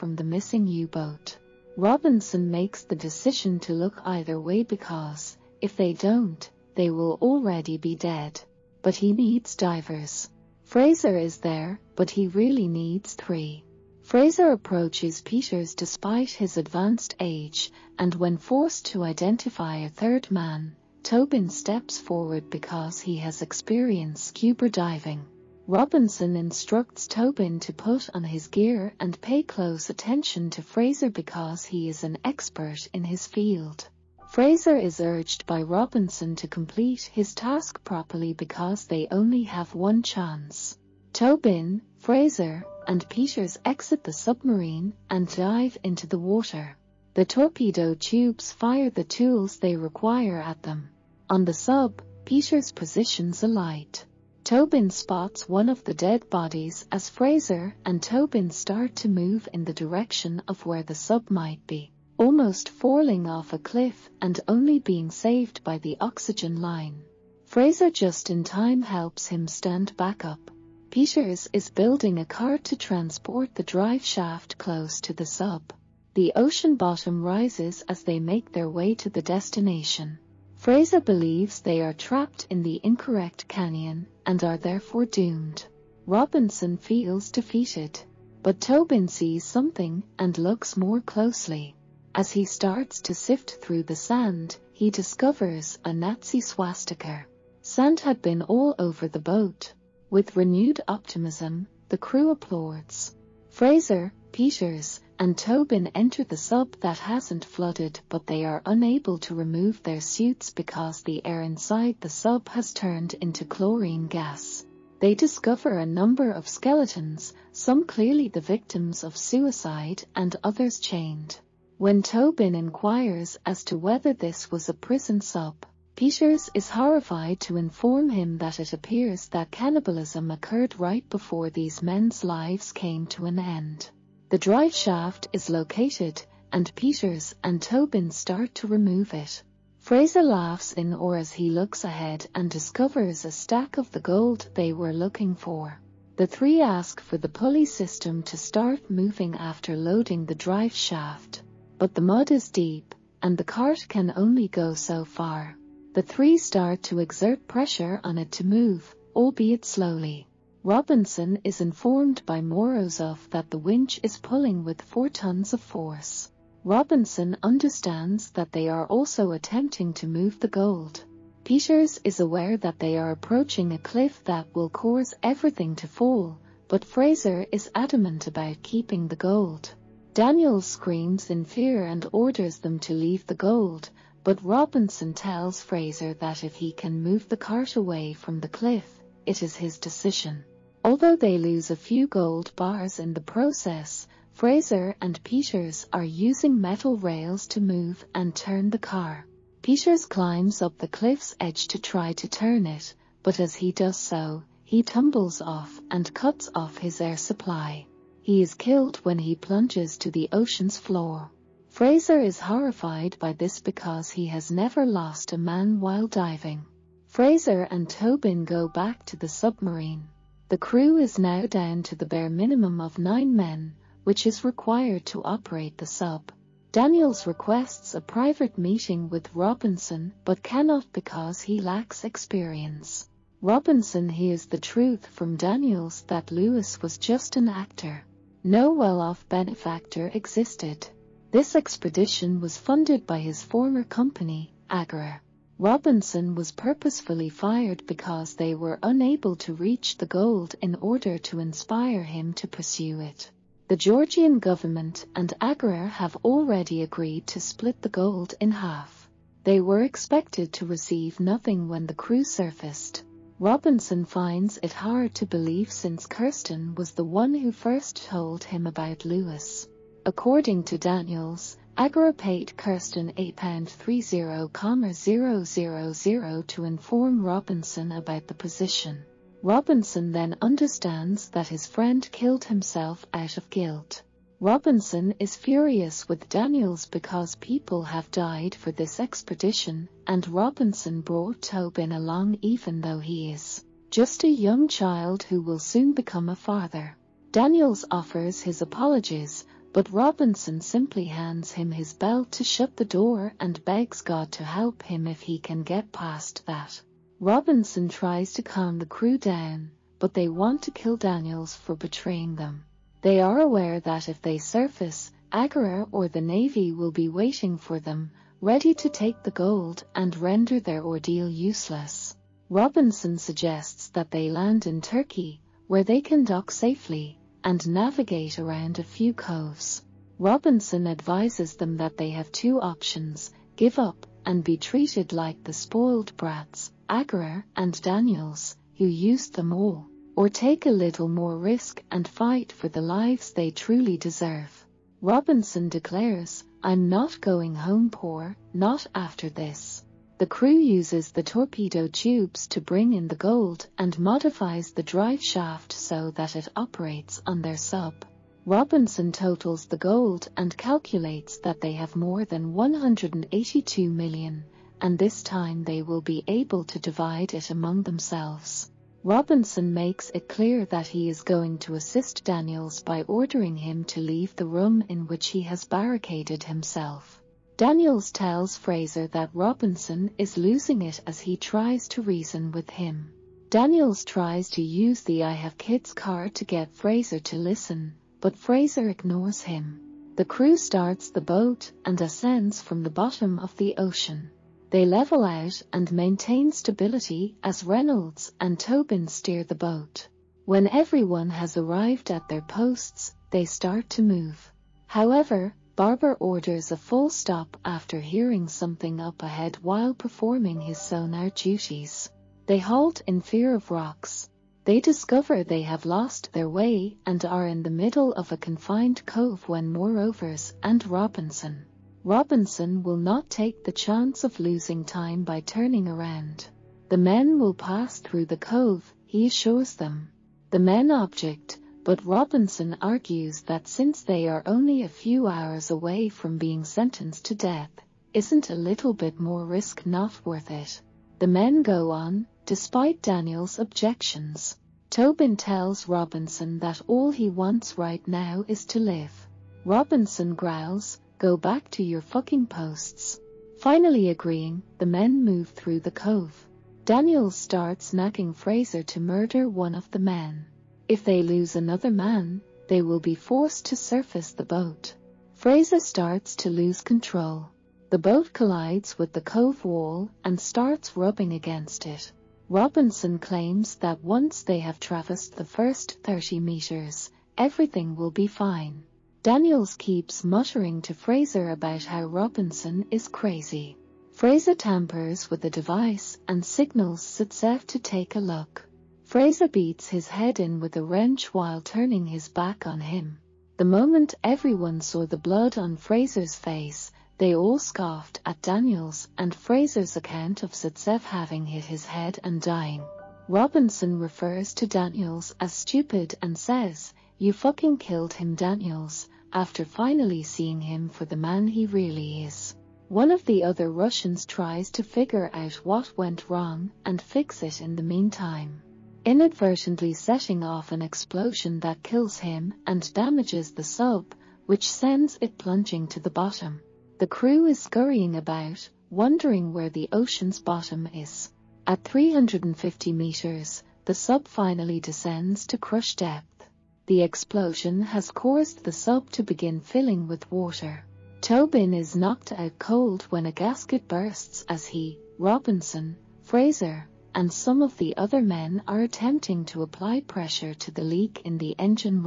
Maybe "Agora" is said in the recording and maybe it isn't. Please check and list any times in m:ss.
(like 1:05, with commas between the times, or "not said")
4:31, 5:15.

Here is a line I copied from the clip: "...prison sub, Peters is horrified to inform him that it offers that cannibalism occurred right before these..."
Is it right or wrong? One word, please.
wrong.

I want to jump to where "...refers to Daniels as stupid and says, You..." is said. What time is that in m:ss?
8:23.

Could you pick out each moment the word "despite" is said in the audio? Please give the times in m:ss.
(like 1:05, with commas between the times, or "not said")
0:15, 7:22.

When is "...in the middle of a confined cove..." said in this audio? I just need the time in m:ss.
6:57.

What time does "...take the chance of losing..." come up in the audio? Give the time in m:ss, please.
7:03.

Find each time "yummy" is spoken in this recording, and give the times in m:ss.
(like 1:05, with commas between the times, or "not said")
not said.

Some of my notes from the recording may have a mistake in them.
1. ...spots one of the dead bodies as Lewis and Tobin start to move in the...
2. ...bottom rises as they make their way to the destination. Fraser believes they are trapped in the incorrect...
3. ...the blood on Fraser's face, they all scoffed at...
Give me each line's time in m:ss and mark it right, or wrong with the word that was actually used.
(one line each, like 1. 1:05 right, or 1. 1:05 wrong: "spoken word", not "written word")
1. 0:54 wrong: "Fraser", not "Lewis"
2. 1:16 right
3. 8:15 right.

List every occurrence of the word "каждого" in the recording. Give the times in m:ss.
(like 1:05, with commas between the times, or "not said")
not said.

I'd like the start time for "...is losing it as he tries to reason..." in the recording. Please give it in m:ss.
6:20.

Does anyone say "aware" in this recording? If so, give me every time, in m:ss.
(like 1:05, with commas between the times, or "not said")
2:52, 5:13.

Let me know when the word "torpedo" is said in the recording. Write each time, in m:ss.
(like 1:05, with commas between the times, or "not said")
0:47, 5:51.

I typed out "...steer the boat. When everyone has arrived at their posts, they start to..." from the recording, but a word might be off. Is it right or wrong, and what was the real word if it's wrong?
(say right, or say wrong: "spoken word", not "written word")
right.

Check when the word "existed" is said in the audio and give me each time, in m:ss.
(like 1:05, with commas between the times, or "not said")
4:00.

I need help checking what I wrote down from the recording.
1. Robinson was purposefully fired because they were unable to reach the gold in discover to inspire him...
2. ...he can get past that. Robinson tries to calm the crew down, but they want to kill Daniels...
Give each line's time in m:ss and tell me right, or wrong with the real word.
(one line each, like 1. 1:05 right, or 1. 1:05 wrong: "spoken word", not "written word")
1. 4:05 wrong: "order", not "discover"
2. 5:05 right.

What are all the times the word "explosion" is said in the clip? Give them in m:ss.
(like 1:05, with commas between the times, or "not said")
8:40, 8:57.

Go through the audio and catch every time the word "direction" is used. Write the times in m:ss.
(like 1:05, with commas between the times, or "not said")
0:59.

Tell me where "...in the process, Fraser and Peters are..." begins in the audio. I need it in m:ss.
3:12.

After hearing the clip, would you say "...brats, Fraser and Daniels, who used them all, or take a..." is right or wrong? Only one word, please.
wrong.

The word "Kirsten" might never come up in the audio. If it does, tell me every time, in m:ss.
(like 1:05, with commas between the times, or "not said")
4:26, 4:32.